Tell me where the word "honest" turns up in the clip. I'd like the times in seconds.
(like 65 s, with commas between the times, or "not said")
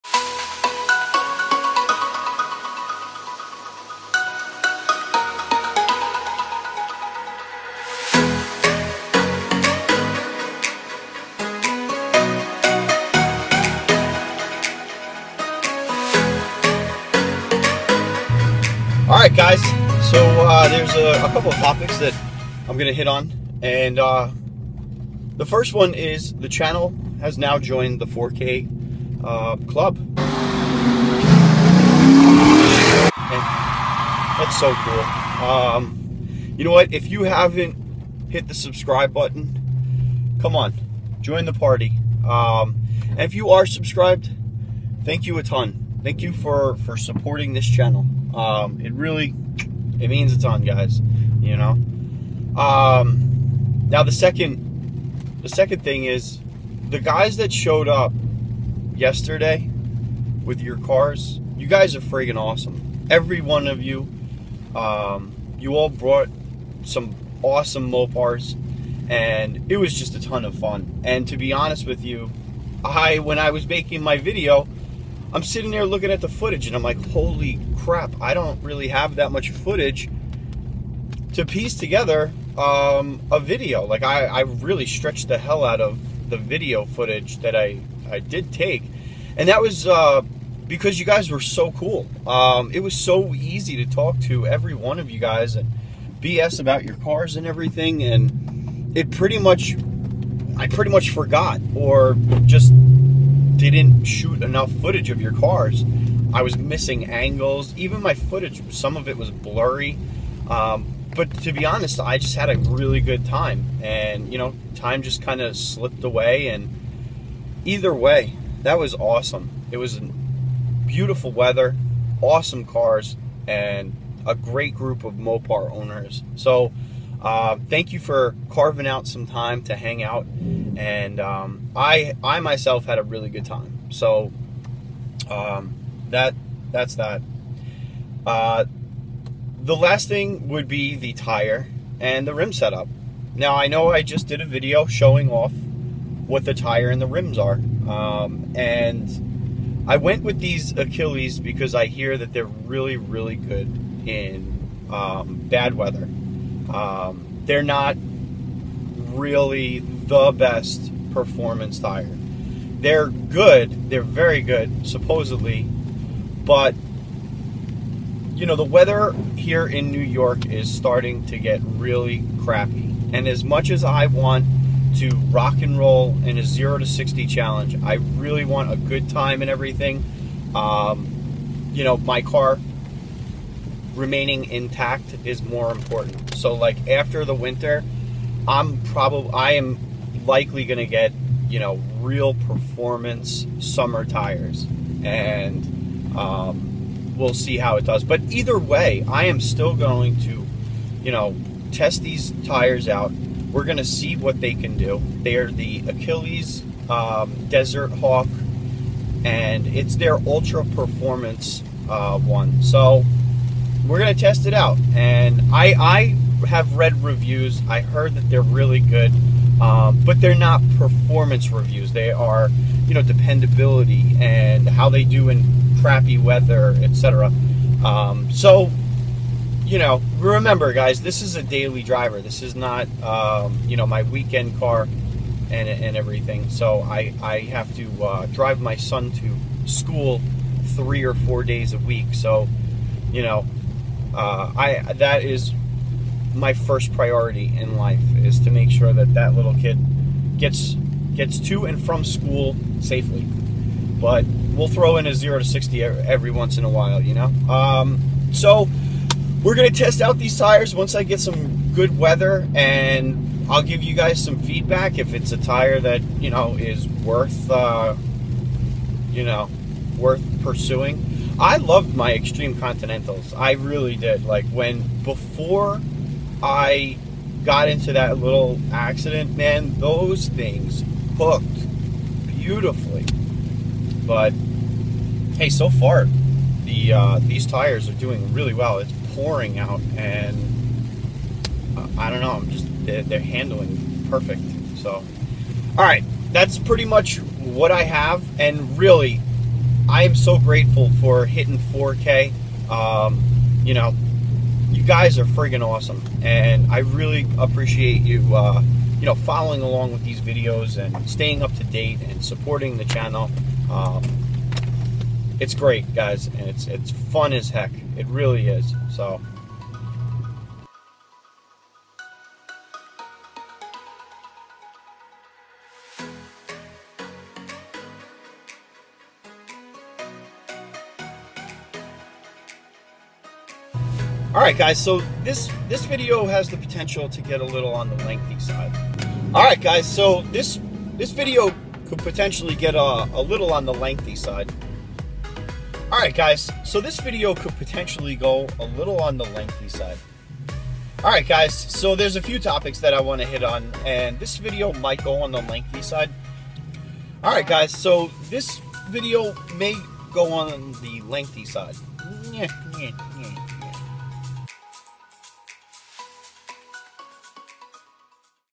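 71 s, 111 s.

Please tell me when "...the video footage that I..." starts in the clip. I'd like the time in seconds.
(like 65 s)
86 s.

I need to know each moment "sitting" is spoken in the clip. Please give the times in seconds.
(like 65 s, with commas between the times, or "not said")
75 s.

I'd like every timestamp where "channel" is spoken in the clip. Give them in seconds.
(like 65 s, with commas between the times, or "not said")
26 s, 47 s, 312 s.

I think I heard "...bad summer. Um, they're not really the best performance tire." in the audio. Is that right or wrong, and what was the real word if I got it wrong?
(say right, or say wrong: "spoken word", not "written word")
wrong: "weather", not "summer".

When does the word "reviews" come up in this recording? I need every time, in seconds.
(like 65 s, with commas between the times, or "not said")
217 s, 221 s.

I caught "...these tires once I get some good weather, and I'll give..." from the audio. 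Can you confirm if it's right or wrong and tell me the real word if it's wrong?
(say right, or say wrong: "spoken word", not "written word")
right.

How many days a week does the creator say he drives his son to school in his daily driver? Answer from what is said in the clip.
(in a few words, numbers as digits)
3 or 4.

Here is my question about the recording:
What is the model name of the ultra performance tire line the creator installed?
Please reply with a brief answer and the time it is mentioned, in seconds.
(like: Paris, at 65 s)
Desert Hawk, at 207 s.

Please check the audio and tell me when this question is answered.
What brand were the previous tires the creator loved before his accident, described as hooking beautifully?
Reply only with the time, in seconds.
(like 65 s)
272 s.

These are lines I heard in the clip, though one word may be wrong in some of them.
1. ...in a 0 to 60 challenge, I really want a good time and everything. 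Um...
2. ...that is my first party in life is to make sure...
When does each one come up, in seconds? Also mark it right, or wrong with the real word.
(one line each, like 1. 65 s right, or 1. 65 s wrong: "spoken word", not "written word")
1. 176 s right
2. 244 s wrong: "priority", not "party".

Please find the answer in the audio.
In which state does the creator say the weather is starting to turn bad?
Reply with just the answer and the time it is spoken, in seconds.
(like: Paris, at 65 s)
New York, at 169 s.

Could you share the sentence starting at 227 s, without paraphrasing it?
Um, so, you know, remember, guys, this is a daily driver.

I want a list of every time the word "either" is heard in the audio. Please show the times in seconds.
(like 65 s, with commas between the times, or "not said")
117 s, 198 s.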